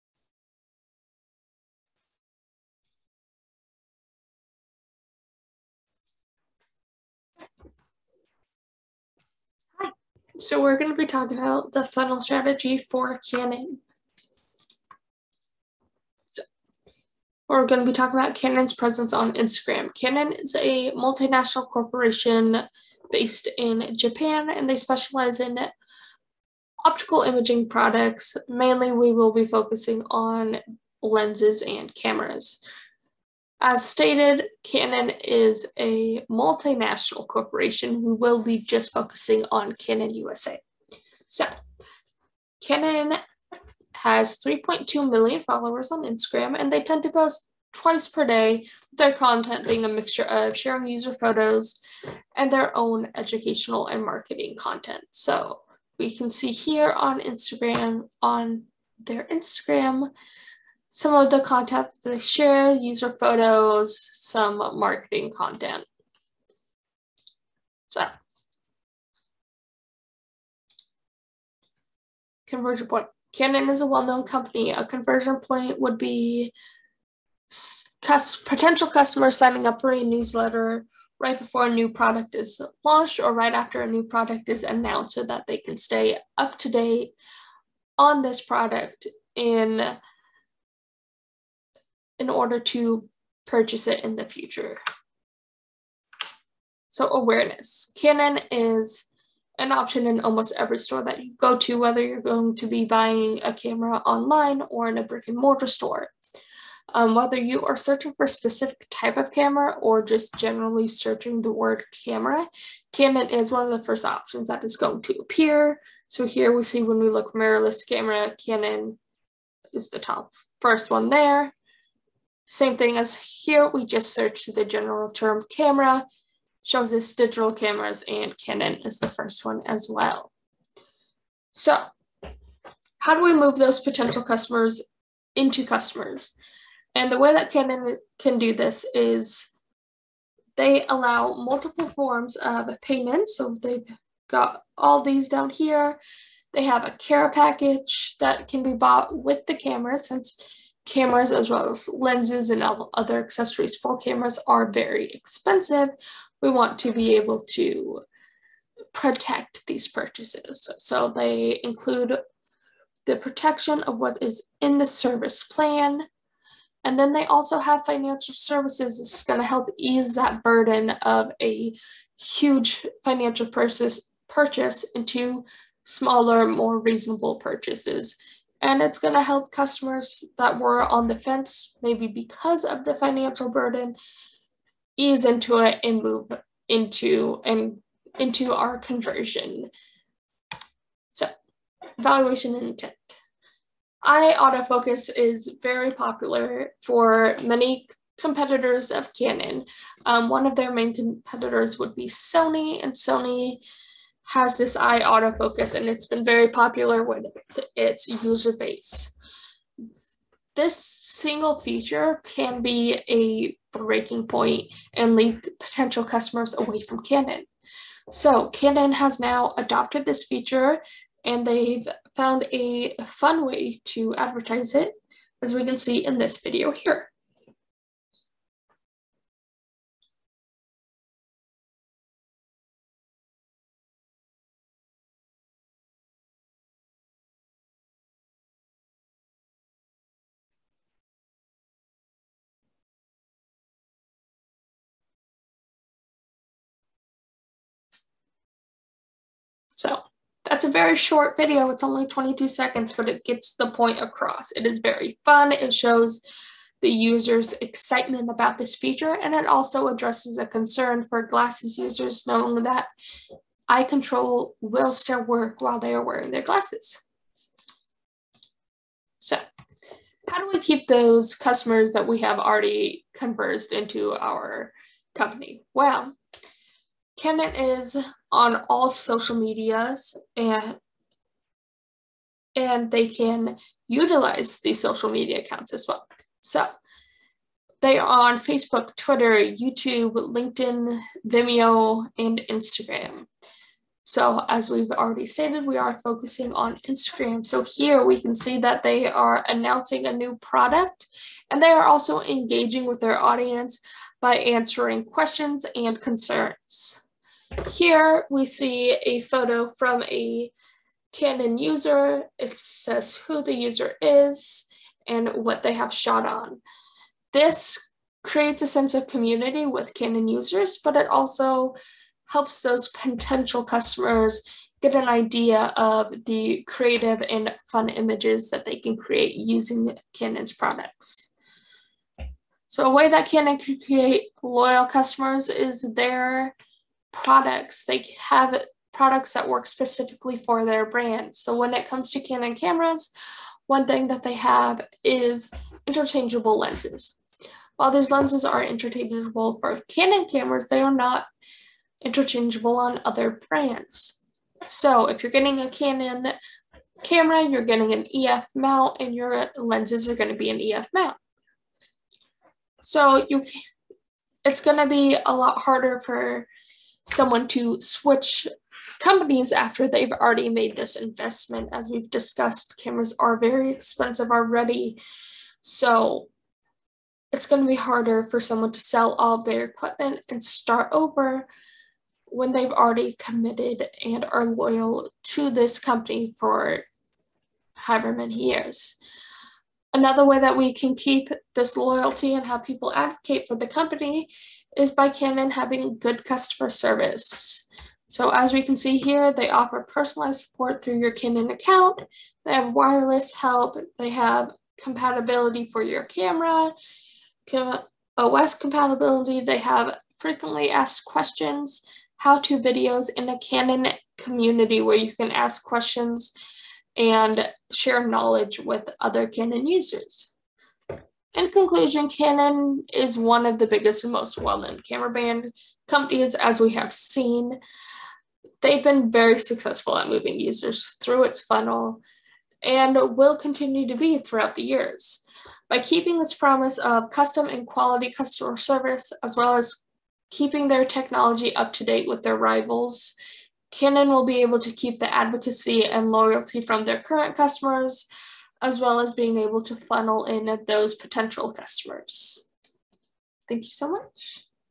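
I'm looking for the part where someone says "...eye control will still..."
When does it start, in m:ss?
4:23.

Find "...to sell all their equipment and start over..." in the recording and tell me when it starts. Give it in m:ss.
6:18.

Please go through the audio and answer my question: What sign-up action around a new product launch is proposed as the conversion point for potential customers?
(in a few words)
signing up for a newsletter.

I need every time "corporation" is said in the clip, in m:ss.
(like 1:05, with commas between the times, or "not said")
0:21, 0:37.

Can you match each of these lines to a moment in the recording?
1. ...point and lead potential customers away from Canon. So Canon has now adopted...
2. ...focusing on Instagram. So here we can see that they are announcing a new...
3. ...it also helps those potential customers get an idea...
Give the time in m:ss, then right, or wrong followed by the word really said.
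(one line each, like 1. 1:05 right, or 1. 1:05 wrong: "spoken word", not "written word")
1. 3:34 right
2. 4:55 right
3. 5:20 right.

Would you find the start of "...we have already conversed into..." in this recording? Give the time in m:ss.
4:32.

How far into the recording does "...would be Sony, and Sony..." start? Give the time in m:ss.
3:21.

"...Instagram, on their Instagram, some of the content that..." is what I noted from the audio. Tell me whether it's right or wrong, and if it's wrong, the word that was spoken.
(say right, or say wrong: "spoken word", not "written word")
right.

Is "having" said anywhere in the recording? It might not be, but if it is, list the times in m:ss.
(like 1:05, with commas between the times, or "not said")
6:35.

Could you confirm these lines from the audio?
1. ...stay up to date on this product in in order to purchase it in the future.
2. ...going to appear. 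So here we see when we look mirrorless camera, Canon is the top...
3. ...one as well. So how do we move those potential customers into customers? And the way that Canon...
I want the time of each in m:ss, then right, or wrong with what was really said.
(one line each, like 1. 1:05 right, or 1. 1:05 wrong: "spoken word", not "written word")
1. 1:25 right
2. 1:54 right
3. 2:09 right.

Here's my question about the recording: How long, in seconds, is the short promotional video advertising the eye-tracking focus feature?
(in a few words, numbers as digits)
22 seconds.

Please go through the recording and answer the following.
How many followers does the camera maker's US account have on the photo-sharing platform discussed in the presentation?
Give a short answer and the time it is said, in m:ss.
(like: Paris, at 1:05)
3.2 million, at 0:44.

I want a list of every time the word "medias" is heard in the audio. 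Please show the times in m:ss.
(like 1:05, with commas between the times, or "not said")
4:39, 4:45.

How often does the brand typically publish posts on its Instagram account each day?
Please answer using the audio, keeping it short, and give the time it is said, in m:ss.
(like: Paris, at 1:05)
twice per day, at 0:47.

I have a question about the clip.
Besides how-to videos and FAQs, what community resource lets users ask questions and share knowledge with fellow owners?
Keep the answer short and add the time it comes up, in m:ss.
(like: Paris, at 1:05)
Canon community, at 6:53.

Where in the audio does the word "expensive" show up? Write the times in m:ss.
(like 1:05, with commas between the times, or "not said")
2:35, 6:13.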